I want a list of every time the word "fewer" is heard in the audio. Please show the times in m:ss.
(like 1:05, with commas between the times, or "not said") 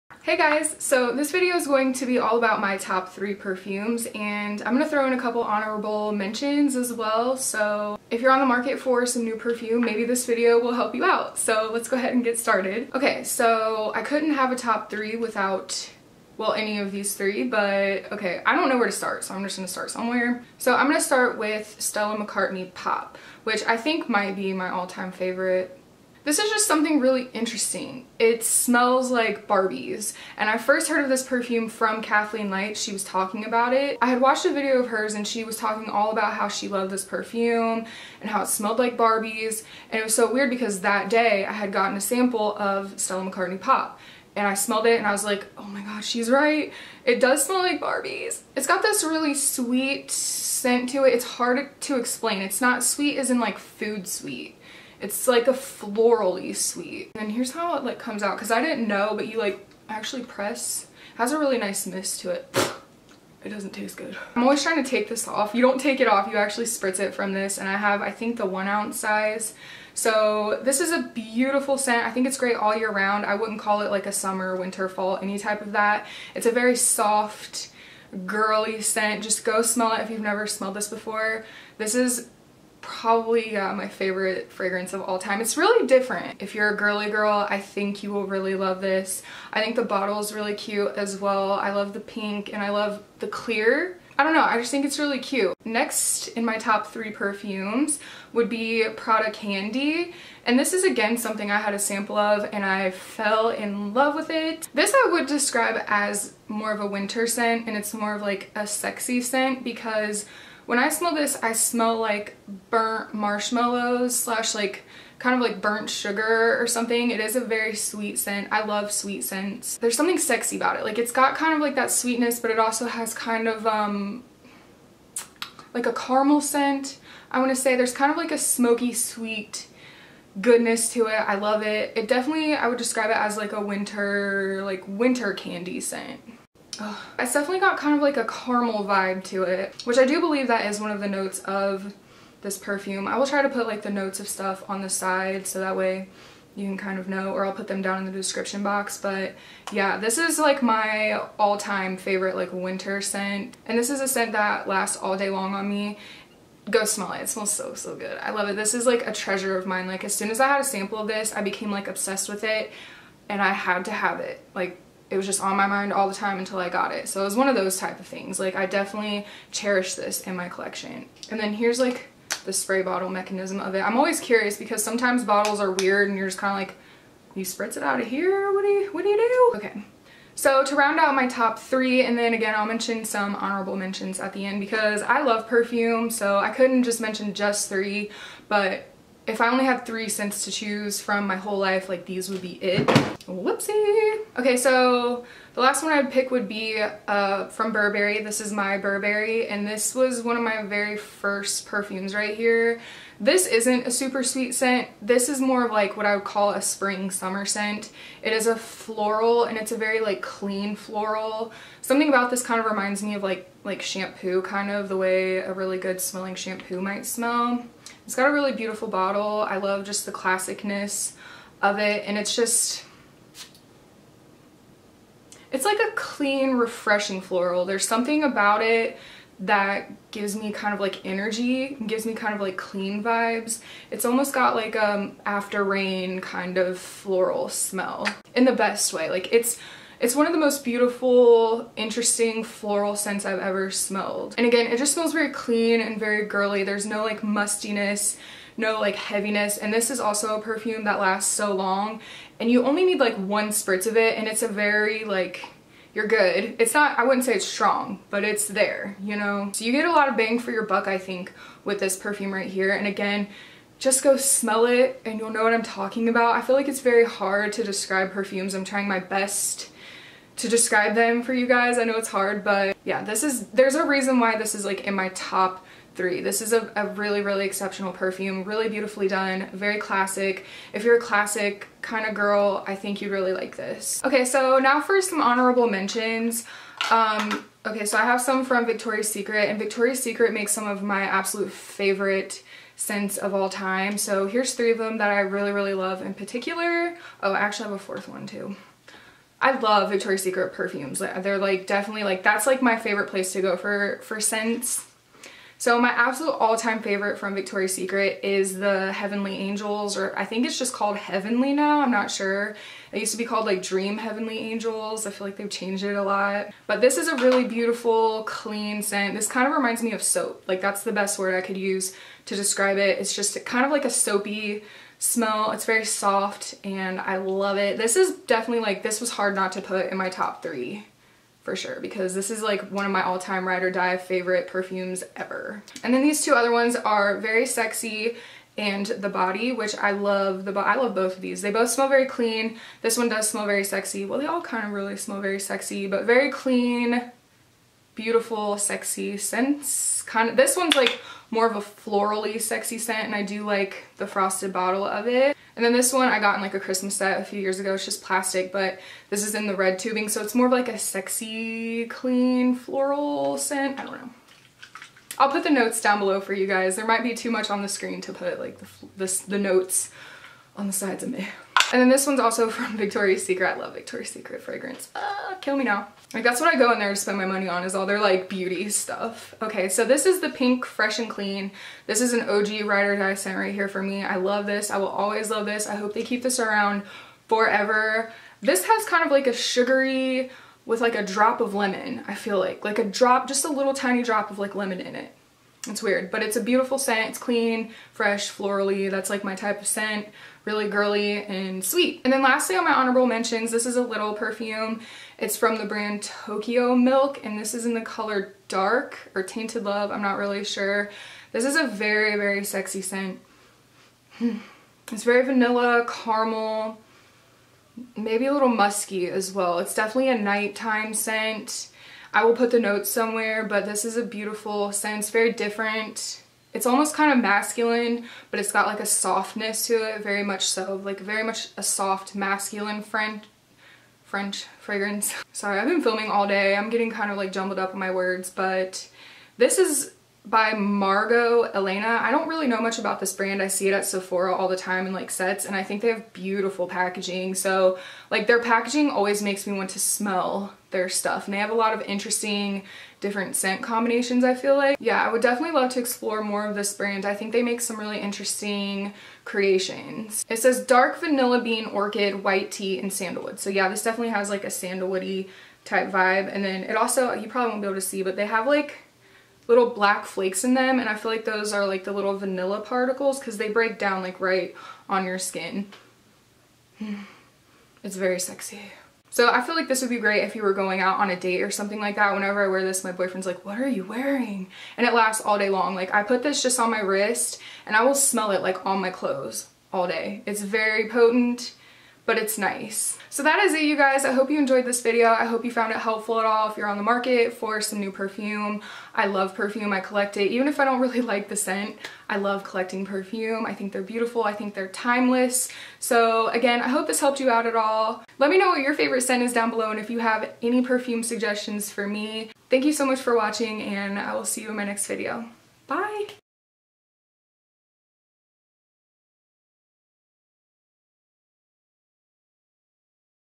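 not said.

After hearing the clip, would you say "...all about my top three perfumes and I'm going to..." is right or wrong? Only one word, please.
right.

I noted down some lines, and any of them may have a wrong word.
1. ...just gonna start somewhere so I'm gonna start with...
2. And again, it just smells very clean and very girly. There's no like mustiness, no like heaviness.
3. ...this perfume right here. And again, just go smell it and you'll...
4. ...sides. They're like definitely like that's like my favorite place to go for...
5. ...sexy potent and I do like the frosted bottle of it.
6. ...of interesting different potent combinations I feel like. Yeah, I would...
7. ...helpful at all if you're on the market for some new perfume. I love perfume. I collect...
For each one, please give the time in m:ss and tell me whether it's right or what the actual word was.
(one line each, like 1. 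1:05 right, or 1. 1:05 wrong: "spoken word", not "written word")
1. 0:19 right
2. 4:04 right
3. 4:21 right
4. 5:00 wrong: "perfumes", not "sides"
5. 5:52 wrong: "scent", not "potent"
6. 7:31 wrong: "scent", not "potent"
7. 8:15 right.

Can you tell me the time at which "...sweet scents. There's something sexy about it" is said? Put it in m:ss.
1:58.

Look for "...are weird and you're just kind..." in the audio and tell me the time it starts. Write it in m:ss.
2:55.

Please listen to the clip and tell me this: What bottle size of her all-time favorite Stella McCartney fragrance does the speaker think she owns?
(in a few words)
1 ounce.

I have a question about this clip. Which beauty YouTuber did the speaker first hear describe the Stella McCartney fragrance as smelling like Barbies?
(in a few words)
Kathleen Light.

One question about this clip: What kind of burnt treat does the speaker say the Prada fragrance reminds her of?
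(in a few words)
burnt marshmallows.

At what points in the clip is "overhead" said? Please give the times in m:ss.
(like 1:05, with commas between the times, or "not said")
not said.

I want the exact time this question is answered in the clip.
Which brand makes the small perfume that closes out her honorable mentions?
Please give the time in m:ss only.
6:46.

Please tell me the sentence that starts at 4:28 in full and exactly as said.
I'm trying my best to describe them for you guys.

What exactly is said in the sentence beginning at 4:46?
Um, okay, so I have some from Victoria's Secret, and Victoria's Secret makes some of my absolute favorite scents of all time.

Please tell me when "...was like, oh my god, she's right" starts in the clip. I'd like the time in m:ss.
0:45.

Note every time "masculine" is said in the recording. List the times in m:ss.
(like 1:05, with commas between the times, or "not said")
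7:07, 7:12.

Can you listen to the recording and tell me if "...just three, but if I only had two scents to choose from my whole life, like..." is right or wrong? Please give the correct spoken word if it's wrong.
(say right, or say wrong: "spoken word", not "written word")
wrong: "three", not "two".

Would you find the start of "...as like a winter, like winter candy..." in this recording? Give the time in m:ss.
2:13.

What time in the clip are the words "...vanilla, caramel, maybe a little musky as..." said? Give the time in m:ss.
6:55.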